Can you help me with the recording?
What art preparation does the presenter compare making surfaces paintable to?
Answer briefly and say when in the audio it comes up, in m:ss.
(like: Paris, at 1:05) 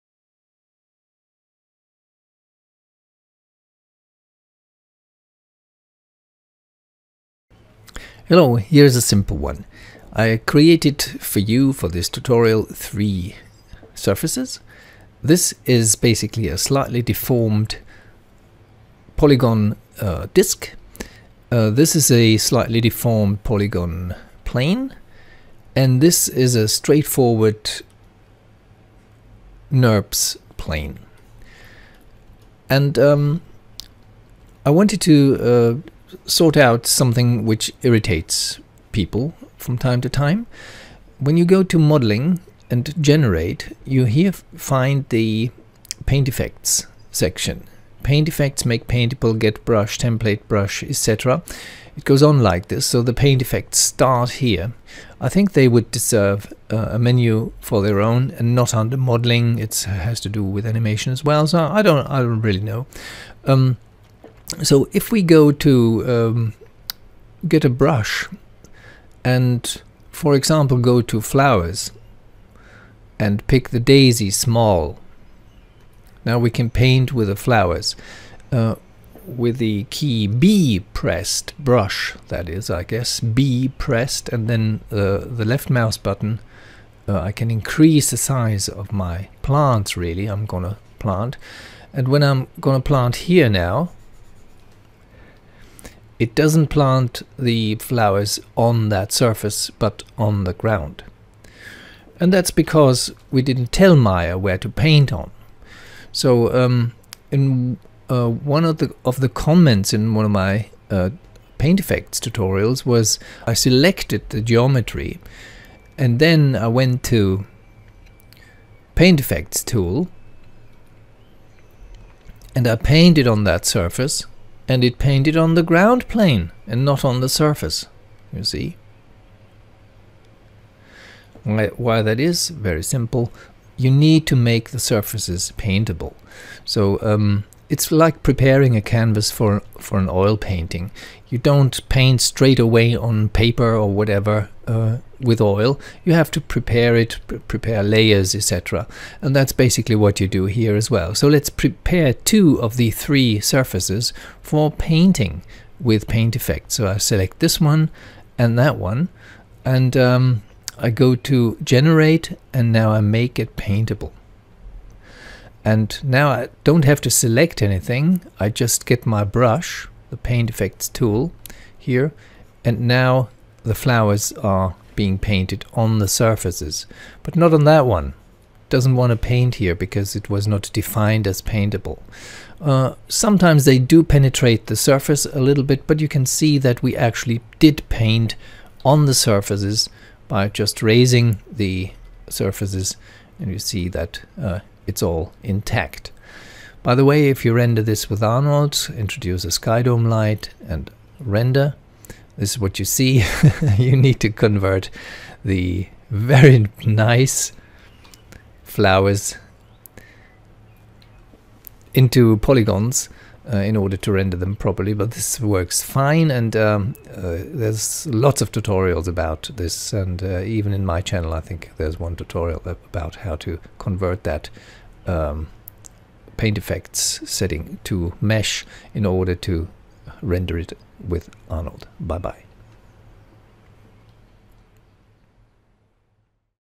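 oil painting, at 2:20.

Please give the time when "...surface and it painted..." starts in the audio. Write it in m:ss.
2:03.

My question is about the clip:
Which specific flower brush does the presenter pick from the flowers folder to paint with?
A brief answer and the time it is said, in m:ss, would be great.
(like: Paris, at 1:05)
daisy small, at 1:13.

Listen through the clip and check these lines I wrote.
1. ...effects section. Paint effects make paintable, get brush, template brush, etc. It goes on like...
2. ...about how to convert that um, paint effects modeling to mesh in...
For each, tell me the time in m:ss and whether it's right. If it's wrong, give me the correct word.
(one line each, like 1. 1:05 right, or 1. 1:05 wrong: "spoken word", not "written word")
1. 0:46 right
2. 3:42 wrong: "setting", not "modeling".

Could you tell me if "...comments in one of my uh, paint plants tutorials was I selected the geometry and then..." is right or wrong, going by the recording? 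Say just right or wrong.
wrong.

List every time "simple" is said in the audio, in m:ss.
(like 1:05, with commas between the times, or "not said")
0:09, 2:12.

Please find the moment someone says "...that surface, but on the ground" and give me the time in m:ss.
1:38.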